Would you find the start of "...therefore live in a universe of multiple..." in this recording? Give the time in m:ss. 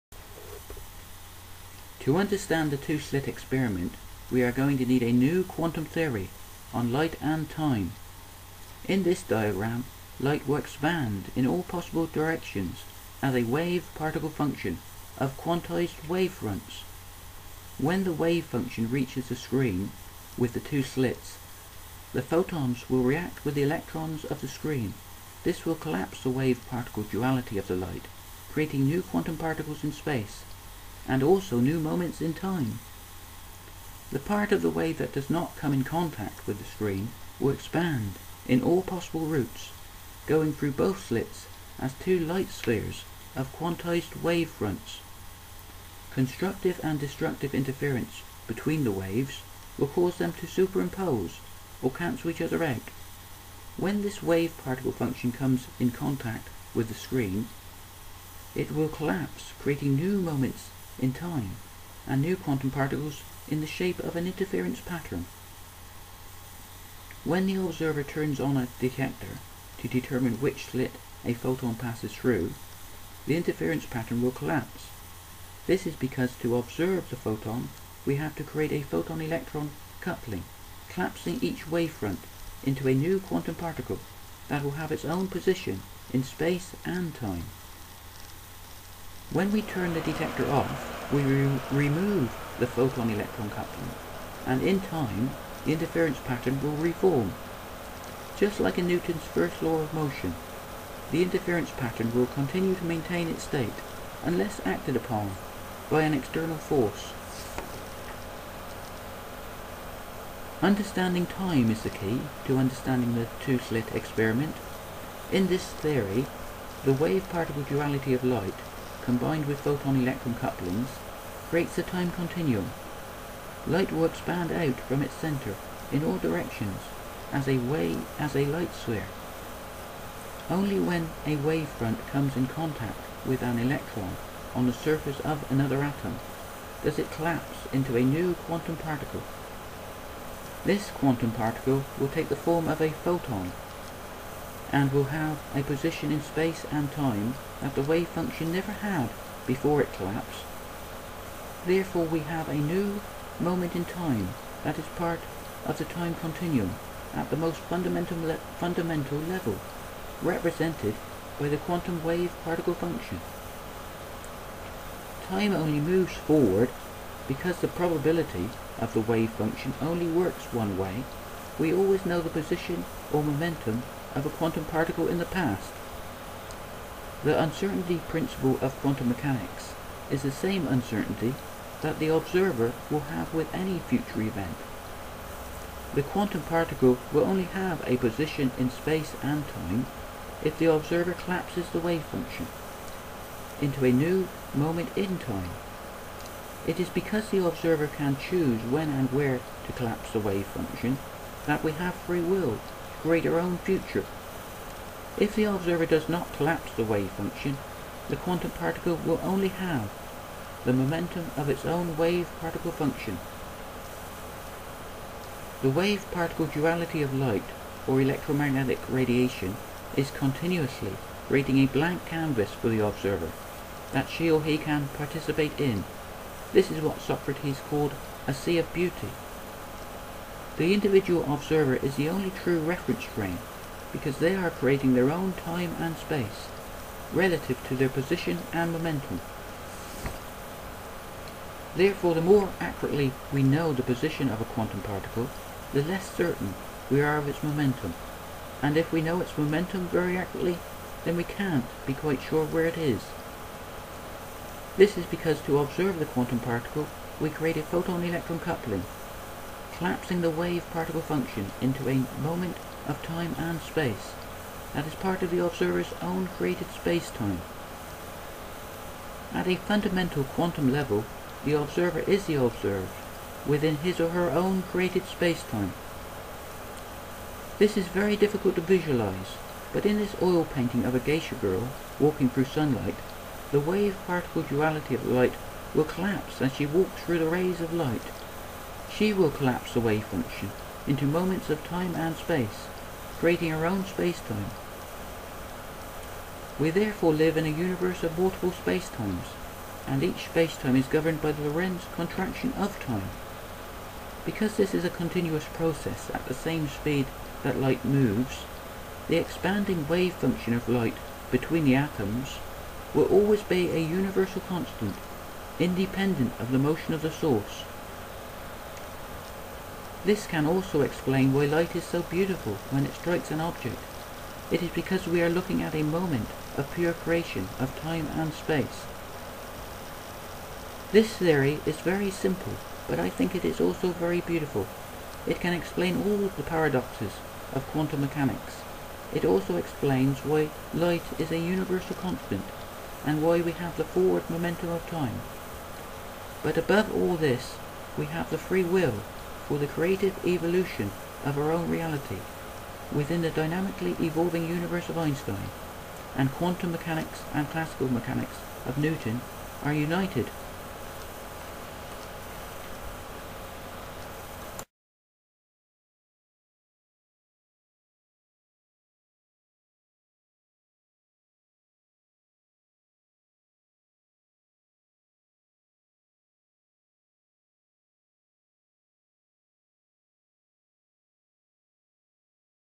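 4:56.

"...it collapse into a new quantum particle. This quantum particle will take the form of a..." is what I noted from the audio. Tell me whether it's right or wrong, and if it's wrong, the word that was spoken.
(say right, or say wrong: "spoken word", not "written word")
right.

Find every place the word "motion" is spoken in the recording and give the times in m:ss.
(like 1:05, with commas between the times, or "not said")
1:39, 5:16.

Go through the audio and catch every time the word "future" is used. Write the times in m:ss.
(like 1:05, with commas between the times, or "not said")
3:03, 3:23.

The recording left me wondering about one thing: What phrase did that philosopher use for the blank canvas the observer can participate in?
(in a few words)
a sea of beauty.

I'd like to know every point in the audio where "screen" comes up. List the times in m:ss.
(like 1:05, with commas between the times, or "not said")
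0:19, 0:24, 0:36, 0:56.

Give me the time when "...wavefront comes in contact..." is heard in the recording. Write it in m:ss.
2:11.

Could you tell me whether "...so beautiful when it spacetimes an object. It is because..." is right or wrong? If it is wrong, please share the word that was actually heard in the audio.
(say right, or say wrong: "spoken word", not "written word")
wrong: "strikes", not "spacetimes".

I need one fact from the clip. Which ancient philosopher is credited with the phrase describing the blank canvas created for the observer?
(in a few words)
Socrates.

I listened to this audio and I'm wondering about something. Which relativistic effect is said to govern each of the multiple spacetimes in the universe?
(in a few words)
Lorentz contraction.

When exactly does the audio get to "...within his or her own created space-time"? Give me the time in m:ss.
4:33.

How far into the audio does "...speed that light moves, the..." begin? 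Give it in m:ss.
5:06.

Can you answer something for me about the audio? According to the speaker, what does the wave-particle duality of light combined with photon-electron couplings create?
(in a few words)
a time continuum.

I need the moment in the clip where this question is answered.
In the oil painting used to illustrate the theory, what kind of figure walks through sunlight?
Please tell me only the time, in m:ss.
4:40.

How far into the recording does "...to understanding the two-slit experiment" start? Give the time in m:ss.
1:52.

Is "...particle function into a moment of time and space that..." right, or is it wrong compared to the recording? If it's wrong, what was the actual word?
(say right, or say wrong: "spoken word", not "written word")
right.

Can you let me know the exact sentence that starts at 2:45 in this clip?
Time only moves forward because the probability of the wave function only works one way.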